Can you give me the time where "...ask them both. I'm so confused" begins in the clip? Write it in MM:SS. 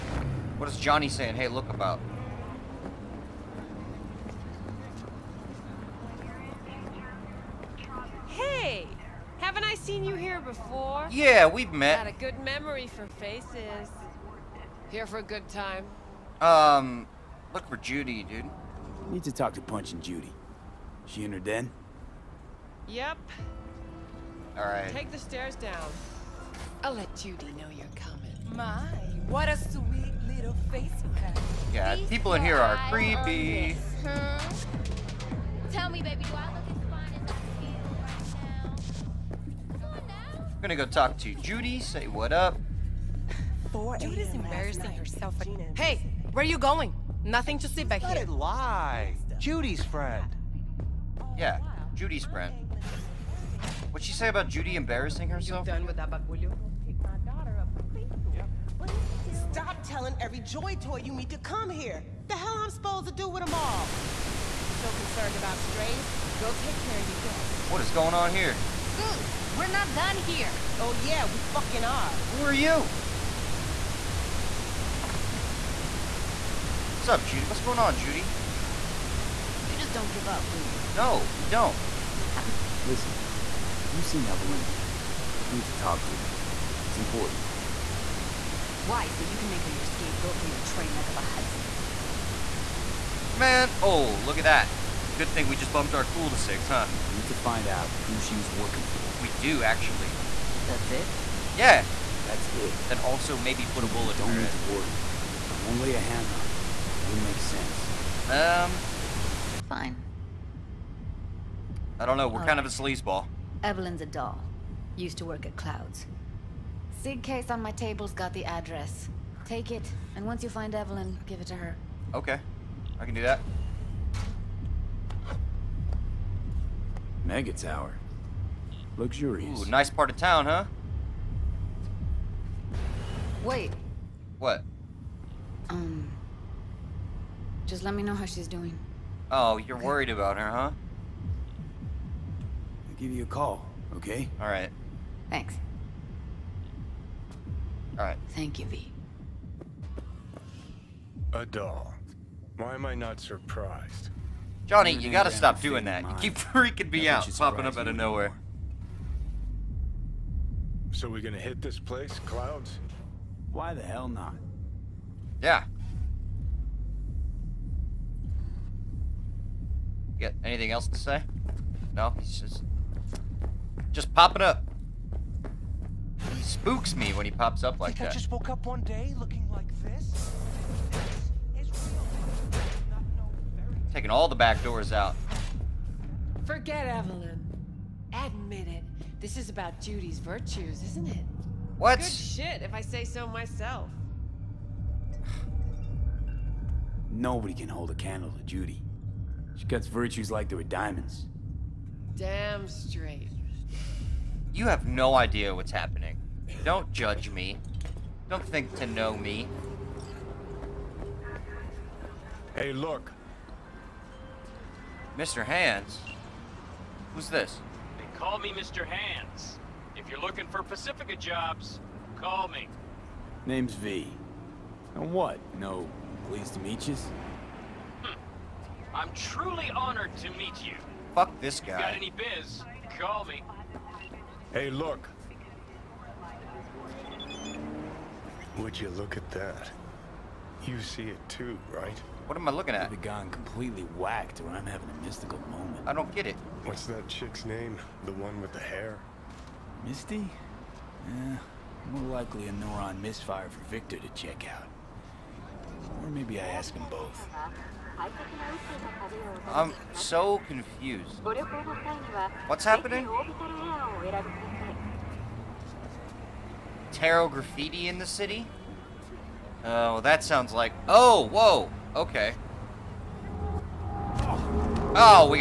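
04:16.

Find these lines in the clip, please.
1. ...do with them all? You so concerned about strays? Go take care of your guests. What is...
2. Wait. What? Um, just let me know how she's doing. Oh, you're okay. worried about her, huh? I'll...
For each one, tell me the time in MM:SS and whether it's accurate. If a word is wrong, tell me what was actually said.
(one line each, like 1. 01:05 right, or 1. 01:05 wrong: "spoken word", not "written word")
1. 01:03 right
2. 02:13 right.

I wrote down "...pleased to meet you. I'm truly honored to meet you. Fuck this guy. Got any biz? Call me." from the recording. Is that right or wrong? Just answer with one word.
right.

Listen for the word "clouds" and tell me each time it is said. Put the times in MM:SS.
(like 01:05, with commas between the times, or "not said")
01:55, 02:42.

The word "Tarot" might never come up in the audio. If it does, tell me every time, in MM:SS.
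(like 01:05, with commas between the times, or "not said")
04:26.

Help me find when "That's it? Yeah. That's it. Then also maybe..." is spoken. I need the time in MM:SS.
01:40.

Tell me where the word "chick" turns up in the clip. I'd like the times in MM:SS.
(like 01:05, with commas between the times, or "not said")
04:07.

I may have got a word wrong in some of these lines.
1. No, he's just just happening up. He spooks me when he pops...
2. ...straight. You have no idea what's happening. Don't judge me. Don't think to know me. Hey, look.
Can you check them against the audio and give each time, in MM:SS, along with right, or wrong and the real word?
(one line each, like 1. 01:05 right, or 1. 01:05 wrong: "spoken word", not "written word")
1. 02:51 wrong: "popping", not "happening"
2. 03:22 right.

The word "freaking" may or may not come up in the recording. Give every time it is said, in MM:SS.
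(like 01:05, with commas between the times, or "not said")
02:36.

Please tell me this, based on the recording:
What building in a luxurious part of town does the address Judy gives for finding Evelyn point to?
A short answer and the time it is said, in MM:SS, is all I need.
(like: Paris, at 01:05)
Mega Tower, at 02:07.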